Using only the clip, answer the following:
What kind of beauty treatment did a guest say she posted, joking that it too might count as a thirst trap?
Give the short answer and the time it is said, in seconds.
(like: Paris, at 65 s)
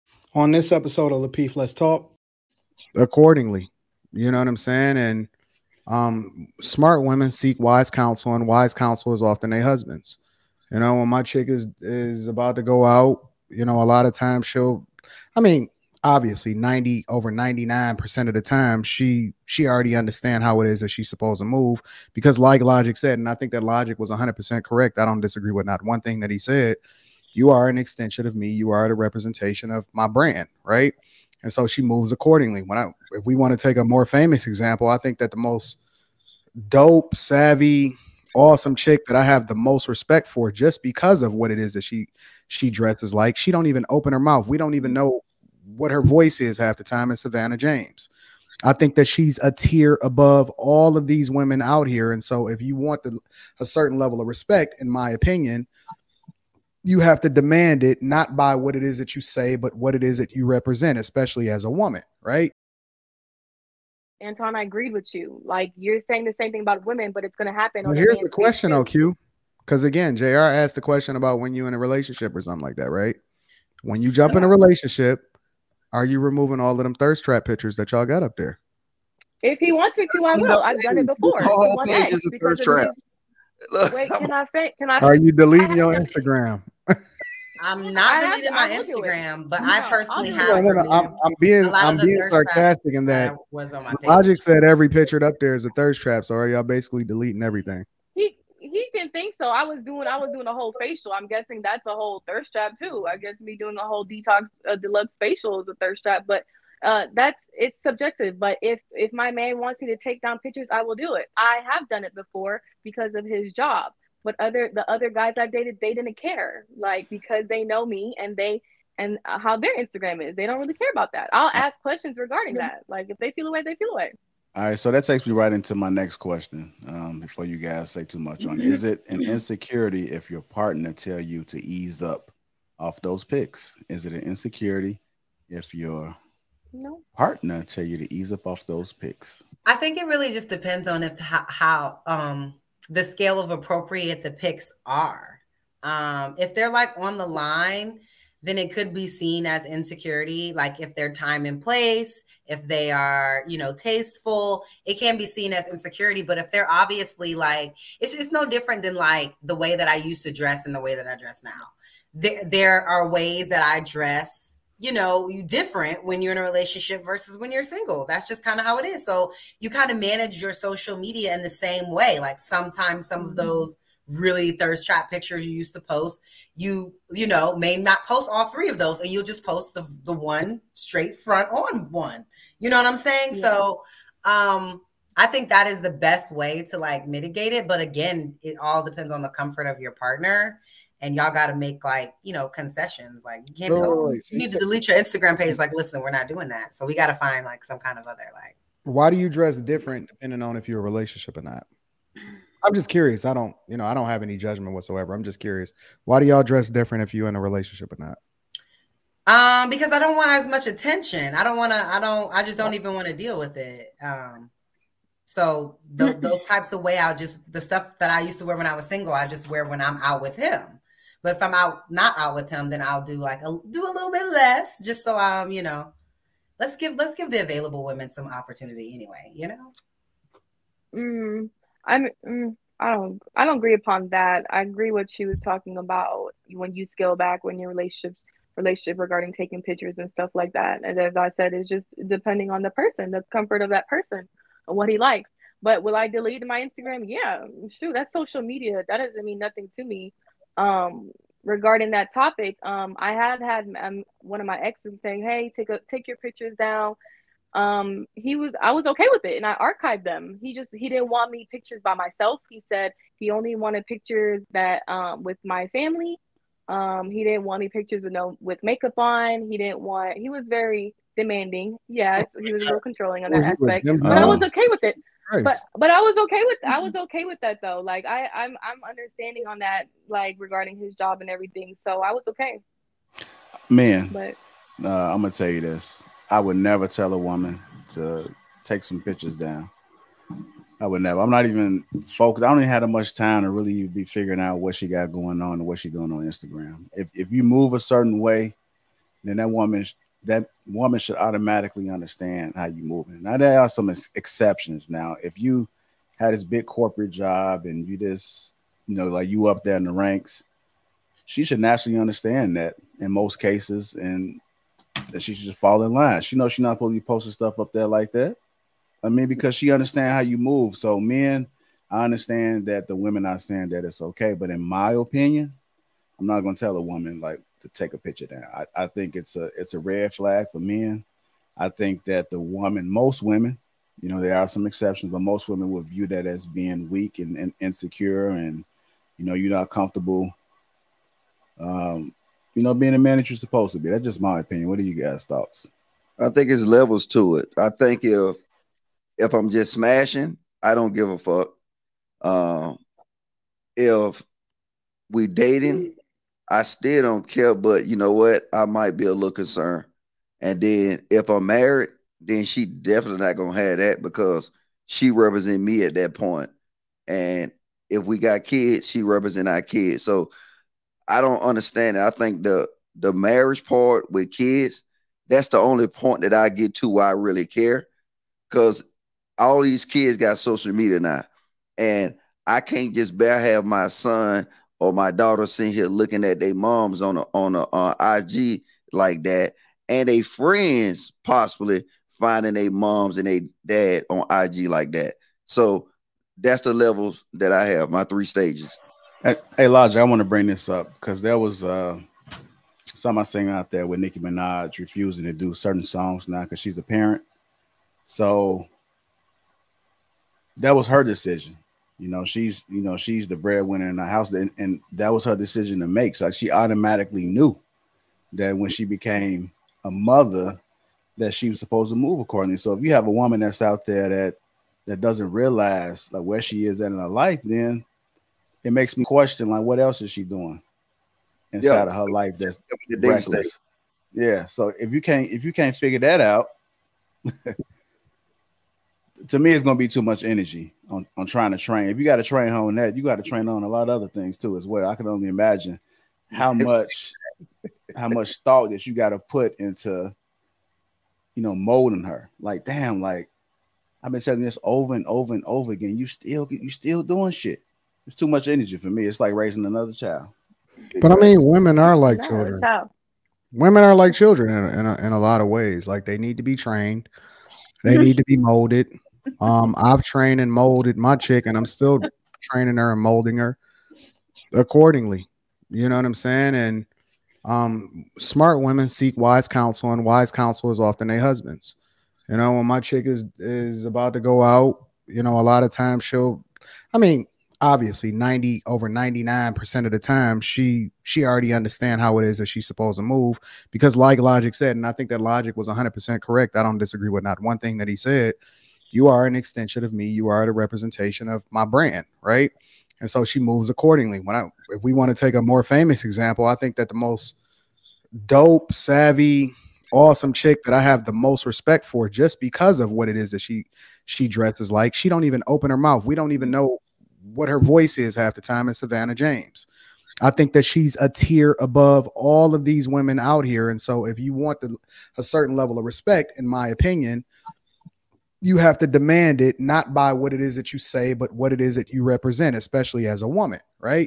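Deluxe facial, at 104 s.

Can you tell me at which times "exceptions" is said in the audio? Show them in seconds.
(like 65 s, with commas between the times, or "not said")
304 s, 334 s.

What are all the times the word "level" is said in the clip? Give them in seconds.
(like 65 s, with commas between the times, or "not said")
53 s, 346 s, 396 s, 525 s.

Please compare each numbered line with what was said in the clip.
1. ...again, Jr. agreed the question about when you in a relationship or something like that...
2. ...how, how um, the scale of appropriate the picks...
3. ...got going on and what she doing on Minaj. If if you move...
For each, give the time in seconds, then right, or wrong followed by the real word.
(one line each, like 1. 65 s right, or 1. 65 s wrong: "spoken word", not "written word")
1. 69 s wrong: "asked", not "agreed"
2. 141 s right
3. 294 s wrong: "Instagram", not "Minaj".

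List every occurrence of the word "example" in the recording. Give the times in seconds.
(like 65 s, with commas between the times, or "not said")
34 s, 506 s.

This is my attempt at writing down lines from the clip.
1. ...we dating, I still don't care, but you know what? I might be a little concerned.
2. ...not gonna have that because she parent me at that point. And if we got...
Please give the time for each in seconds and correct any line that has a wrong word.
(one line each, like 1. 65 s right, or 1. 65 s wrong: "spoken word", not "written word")
1. 355 s right
2. 363 s wrong: "represent", not "parent".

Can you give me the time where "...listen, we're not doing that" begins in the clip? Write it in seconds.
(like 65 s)
195 s.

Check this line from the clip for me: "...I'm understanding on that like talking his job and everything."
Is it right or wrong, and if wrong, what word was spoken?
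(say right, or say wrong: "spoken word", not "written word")
wrong: "regarding", not "talking".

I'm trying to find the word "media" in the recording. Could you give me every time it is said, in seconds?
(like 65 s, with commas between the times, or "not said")
170 s, 248 s, 380 s.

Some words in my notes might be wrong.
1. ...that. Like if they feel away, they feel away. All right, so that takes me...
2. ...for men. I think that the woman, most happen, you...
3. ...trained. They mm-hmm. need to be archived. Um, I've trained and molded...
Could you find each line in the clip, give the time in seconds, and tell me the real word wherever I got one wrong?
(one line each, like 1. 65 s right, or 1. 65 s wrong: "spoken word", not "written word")
1. 122 s right
2. 330 s wrong: "women", not "happen"
3. 466 s wrong: "molded", not "archived".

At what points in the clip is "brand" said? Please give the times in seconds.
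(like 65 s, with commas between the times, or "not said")
30 s, 501 s.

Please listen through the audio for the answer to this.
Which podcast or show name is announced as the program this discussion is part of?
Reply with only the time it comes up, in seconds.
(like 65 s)
1 s.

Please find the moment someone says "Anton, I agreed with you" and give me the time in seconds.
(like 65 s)
64 s.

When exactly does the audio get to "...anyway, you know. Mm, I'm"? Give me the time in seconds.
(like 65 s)
228 s.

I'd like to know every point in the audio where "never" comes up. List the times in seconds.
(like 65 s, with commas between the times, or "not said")
286 s, 291 s.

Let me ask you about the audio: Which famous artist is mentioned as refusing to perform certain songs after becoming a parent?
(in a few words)
Nicki Minaj.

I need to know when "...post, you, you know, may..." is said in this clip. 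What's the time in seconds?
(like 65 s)
175 s.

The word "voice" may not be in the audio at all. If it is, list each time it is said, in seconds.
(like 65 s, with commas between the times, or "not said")
46 s, 517 s.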